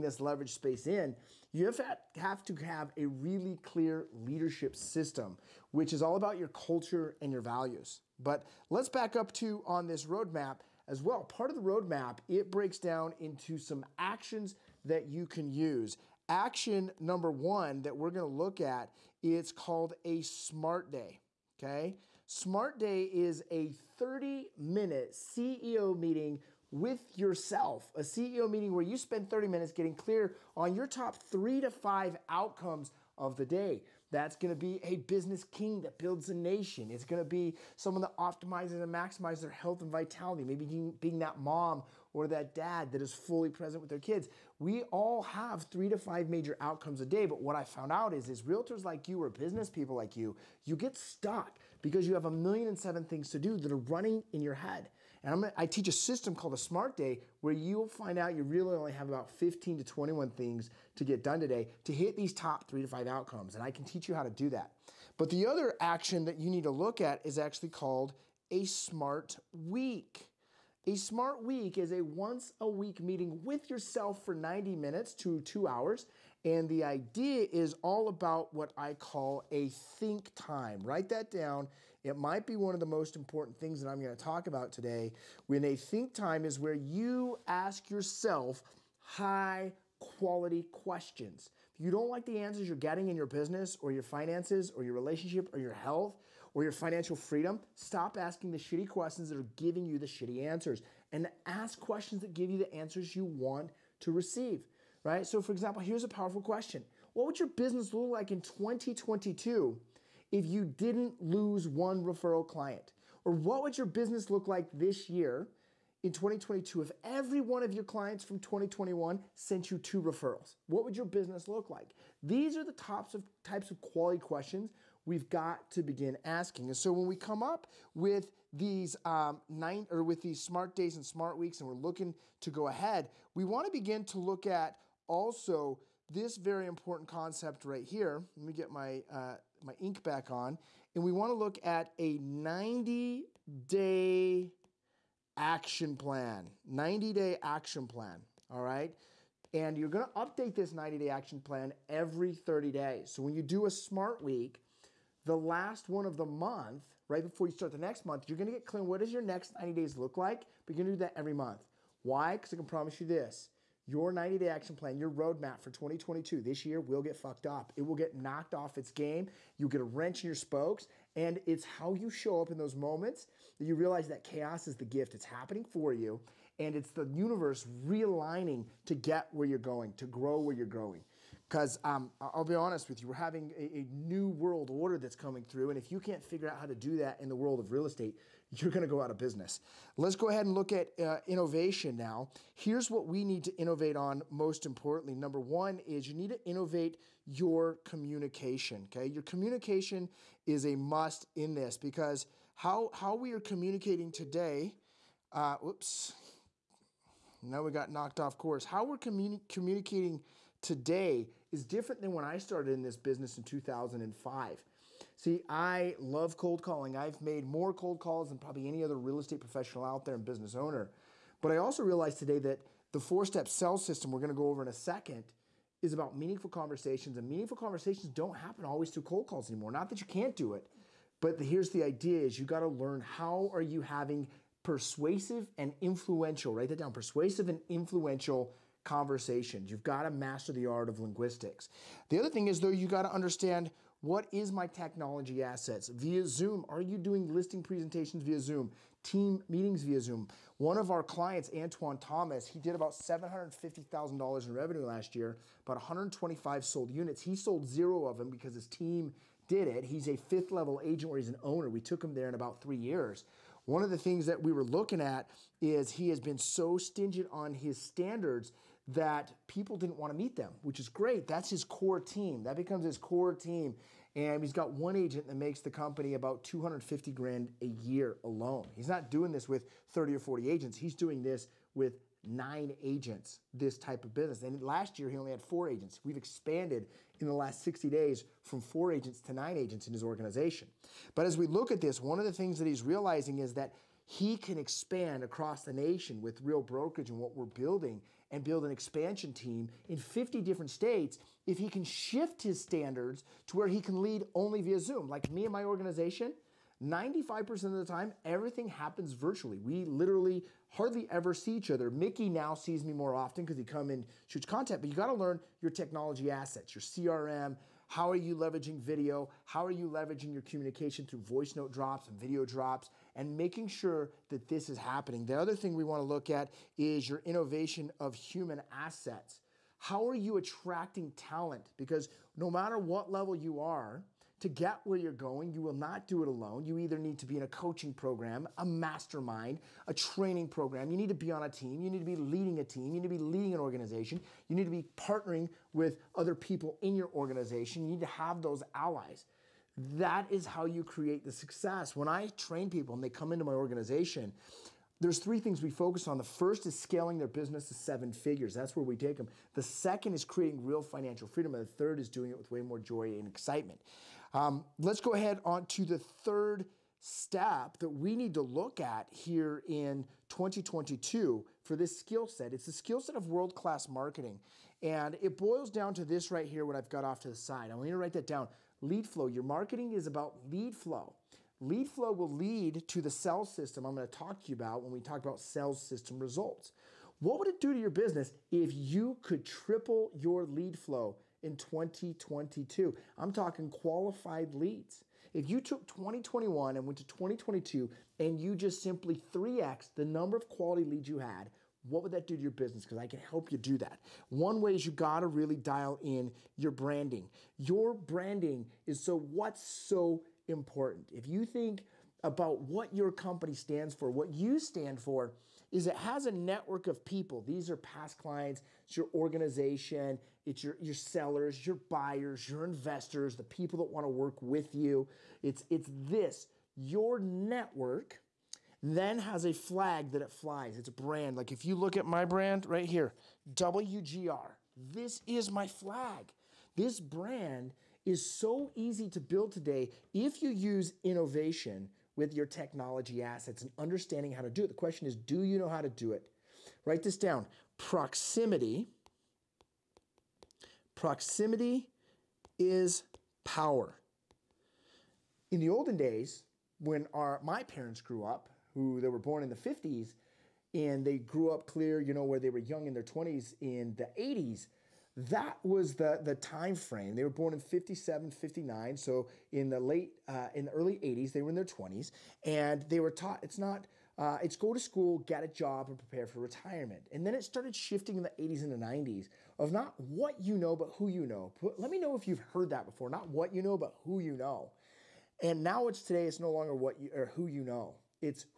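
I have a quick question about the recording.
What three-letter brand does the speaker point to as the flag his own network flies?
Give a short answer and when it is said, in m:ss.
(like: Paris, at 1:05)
WGR, at 7:13.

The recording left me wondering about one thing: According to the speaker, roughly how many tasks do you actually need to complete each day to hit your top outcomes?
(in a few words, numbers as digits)
15 to 21.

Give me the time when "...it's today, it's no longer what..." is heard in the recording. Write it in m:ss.
8:05.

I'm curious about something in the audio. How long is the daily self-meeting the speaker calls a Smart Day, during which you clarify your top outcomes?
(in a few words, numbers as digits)
30 minutes.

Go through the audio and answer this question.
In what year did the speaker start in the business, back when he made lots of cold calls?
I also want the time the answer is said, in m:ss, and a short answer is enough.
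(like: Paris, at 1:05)
2005, at 3:33.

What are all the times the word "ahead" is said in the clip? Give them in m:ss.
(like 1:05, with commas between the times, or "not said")
2:12, 3:10, 6:05.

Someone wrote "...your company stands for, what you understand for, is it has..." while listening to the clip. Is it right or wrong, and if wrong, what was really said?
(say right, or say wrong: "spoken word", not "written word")
wrong: "stand", not "understand".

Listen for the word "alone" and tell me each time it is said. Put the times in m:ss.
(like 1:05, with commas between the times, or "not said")
4:38, 5:36.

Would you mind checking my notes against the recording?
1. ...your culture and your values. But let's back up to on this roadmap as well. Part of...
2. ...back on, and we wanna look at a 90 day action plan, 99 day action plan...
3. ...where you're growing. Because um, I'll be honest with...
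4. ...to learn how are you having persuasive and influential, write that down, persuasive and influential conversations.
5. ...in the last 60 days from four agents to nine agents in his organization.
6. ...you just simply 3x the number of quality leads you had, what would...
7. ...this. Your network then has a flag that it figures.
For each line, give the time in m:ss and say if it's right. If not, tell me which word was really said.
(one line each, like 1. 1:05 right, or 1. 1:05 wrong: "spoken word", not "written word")
1. 0:06 right
2. 2:20 wrong: "90", not "99"
3. 3:00 right
4. 3:52 right
5. 4:47 right
6. 6:38 right
7. 7:06 wrong: "flies", not "figures".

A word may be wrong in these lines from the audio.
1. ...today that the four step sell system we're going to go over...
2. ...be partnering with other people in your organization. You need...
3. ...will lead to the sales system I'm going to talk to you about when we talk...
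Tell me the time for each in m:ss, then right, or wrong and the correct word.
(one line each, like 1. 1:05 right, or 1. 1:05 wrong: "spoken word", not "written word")
1. 3:42 right
2. 5:44 right
3. 6:22 right.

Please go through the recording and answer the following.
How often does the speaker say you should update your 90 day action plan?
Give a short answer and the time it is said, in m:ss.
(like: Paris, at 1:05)
every 30 days, at 2:32.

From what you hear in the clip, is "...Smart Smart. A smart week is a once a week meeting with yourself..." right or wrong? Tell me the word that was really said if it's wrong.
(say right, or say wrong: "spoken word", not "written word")
wrong: "Week", not "Smart".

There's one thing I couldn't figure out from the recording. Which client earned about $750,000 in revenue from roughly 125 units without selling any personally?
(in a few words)
Antoine Thomas.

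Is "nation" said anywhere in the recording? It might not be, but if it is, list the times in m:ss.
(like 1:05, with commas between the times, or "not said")
0:36, 4:55.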